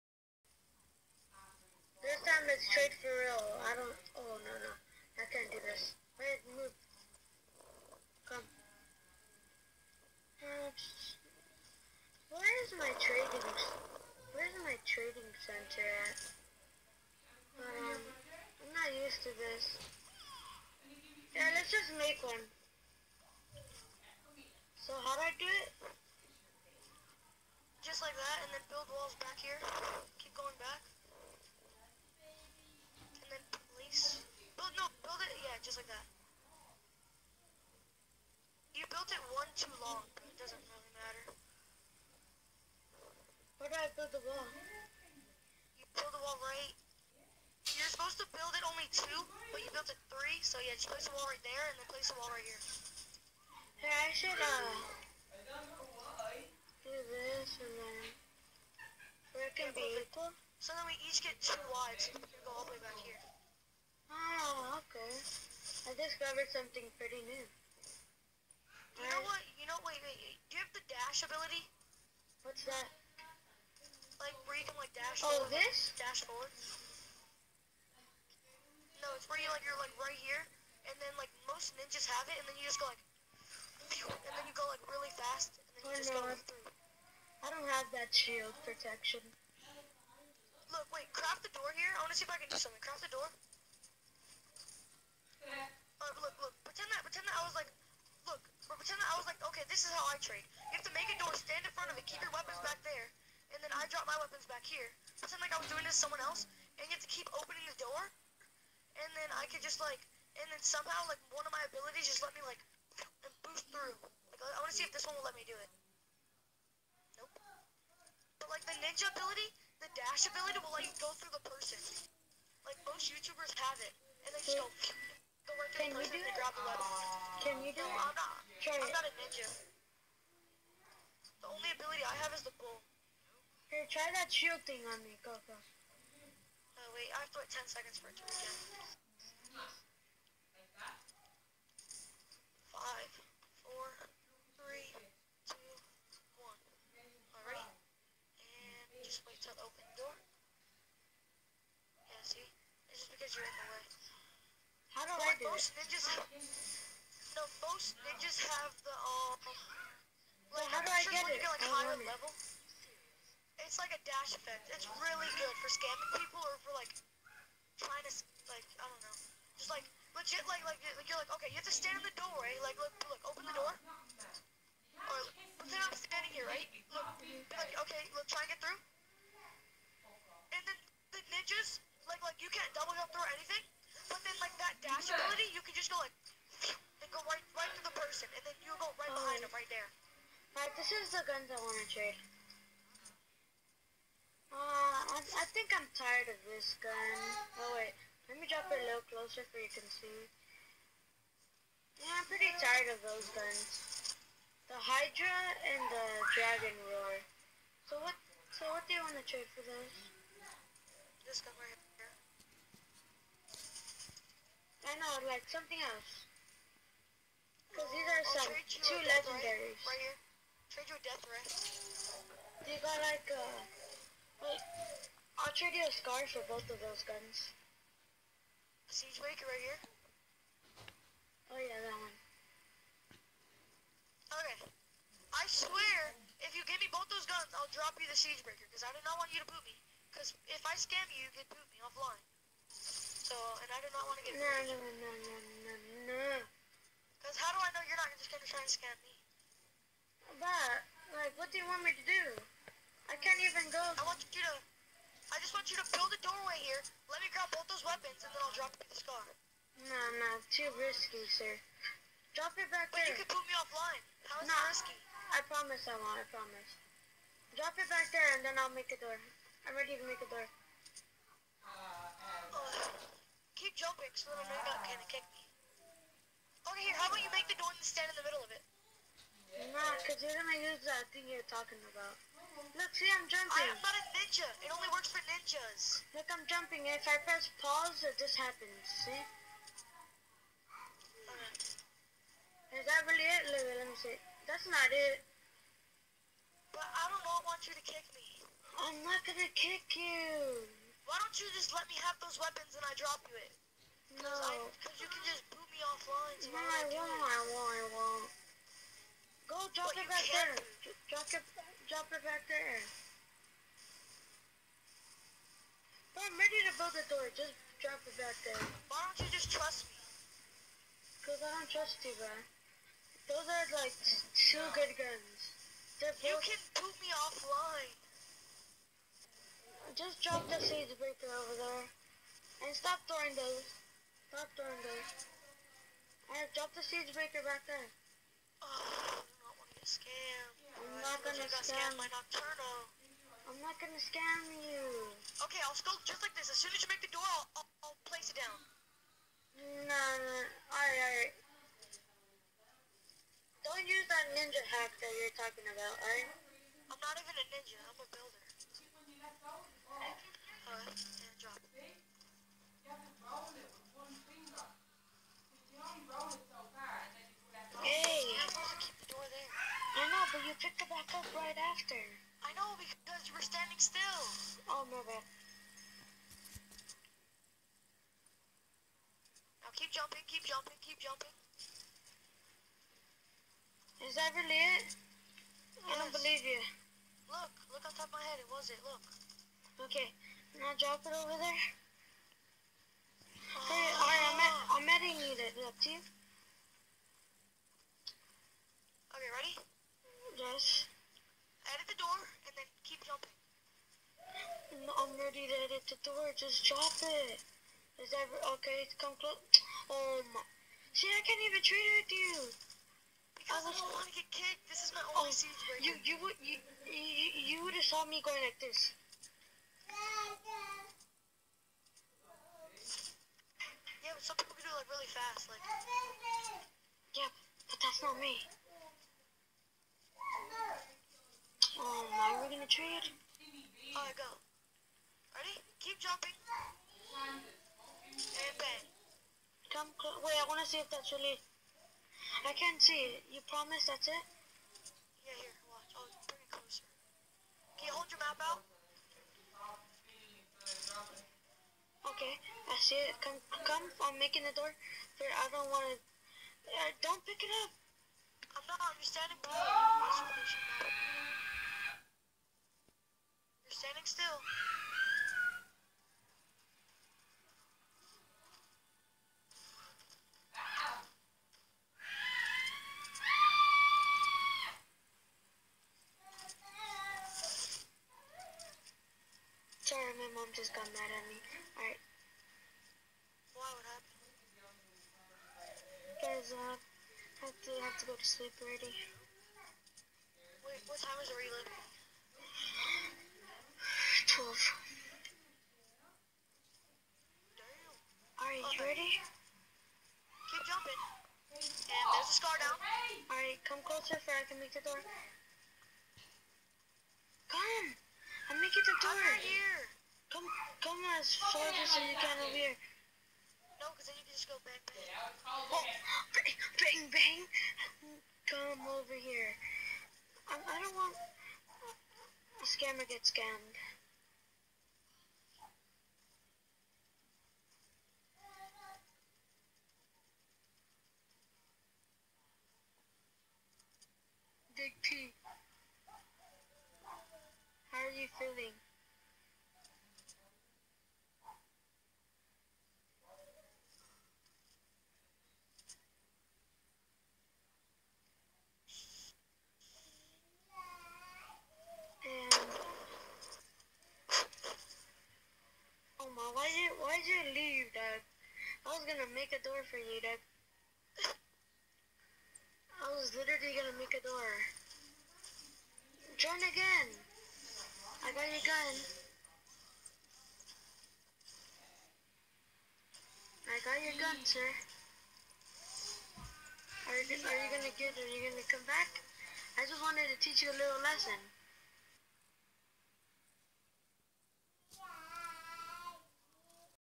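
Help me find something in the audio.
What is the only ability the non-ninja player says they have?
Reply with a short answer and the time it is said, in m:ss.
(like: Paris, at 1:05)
the bull, at 2:12.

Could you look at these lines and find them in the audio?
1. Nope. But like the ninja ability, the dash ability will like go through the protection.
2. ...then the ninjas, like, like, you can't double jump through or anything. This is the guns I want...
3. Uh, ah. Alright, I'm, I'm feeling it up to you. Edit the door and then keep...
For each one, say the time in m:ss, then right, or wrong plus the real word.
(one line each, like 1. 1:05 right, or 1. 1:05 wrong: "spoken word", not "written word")
1. 1:57 wrong: "person", not "protection"
2. 3:00 right
3. 6:33 wrong: "editing", not "feeling".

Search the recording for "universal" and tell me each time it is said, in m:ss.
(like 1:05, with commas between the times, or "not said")
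not said.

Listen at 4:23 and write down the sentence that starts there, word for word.
But you could put me offline.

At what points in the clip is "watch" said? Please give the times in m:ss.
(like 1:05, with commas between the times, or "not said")
7:25.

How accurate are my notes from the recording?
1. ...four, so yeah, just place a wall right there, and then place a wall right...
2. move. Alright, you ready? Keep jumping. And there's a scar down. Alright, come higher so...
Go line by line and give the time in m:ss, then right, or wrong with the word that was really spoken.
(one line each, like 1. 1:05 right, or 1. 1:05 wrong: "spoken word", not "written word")
1. 0:50 wrong: "three", not "four"
2. 8:14 wrong: "closer", not "higher".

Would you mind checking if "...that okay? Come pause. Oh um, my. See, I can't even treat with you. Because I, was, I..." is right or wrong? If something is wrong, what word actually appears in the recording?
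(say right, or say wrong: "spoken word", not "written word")
wrong: "close", not "pause".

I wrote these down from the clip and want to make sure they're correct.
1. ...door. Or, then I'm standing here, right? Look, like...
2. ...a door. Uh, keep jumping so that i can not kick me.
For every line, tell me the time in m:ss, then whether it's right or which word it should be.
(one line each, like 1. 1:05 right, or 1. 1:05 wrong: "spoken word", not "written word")
1. 2:53 right
2. 4:30 right.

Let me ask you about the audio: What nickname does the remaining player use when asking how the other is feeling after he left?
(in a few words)
Big P.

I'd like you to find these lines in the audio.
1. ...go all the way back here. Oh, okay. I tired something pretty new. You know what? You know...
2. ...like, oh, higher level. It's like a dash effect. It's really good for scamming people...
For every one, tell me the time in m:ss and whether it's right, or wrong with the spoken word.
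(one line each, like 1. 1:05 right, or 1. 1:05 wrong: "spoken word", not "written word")
1. 1:02 wrong: "discovered", not "tired"
2. 2:41 right.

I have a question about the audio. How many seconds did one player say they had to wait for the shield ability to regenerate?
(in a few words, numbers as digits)
10.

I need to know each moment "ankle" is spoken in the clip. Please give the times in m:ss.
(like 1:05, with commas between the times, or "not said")
not said.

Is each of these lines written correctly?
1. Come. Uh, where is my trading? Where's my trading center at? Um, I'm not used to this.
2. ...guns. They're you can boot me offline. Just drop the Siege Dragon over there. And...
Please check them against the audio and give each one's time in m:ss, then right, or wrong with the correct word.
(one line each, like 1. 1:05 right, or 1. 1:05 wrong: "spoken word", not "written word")
1. 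0:08 right
2. 5:24 wrong: "Breaker", not "Dragon".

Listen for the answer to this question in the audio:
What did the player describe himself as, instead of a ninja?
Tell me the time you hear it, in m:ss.
5:57.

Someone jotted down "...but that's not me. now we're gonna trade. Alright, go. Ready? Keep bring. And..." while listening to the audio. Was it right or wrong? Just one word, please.
wrong.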